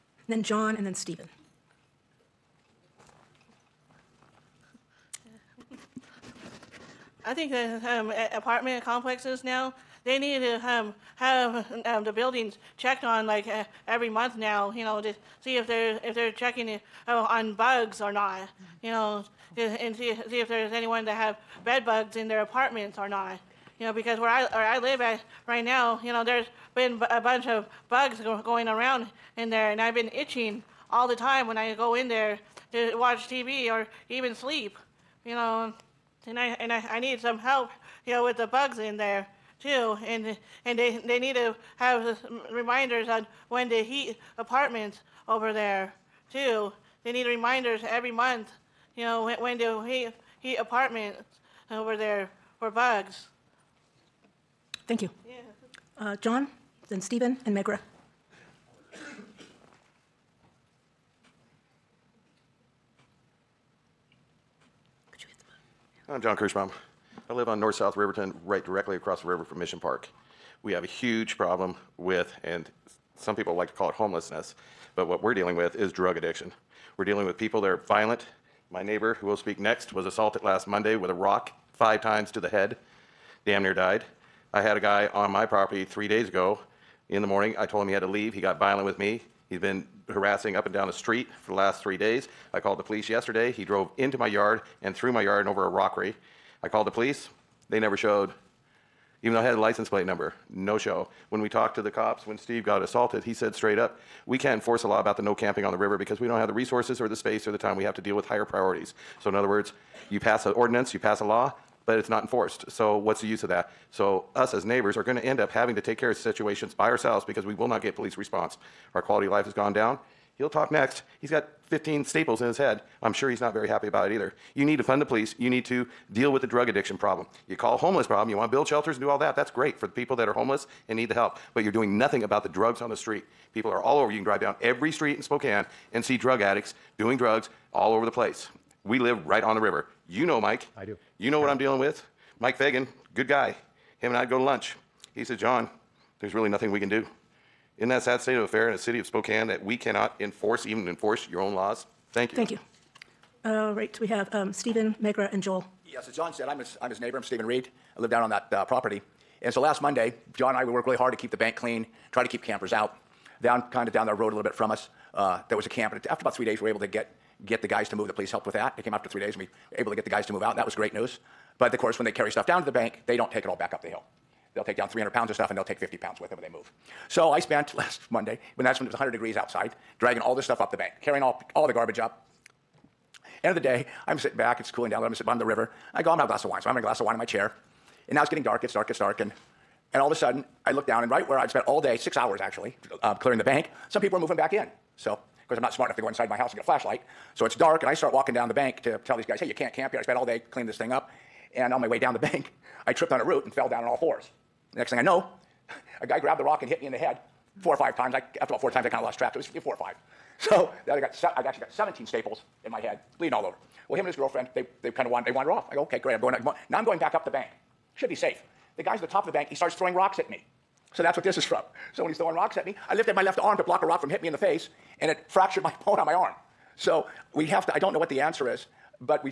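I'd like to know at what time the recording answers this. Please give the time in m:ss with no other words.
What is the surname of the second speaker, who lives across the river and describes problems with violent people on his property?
1:06.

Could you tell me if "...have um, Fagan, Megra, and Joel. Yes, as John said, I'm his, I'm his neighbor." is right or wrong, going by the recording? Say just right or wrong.
wrong.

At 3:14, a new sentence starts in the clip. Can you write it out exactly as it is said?
So because I'm not smart enough to go inside my house and get a flashlight.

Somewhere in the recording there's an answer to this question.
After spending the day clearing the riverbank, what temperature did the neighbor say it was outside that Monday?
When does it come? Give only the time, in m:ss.
2:58.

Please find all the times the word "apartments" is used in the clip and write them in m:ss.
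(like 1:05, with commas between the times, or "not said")
0:08, 0:22, 0:44, 0:50.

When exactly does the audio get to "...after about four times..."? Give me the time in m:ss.
3:28.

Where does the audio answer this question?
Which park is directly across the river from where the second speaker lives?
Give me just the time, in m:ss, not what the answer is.
1:09.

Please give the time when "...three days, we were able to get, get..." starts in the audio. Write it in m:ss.
2:46.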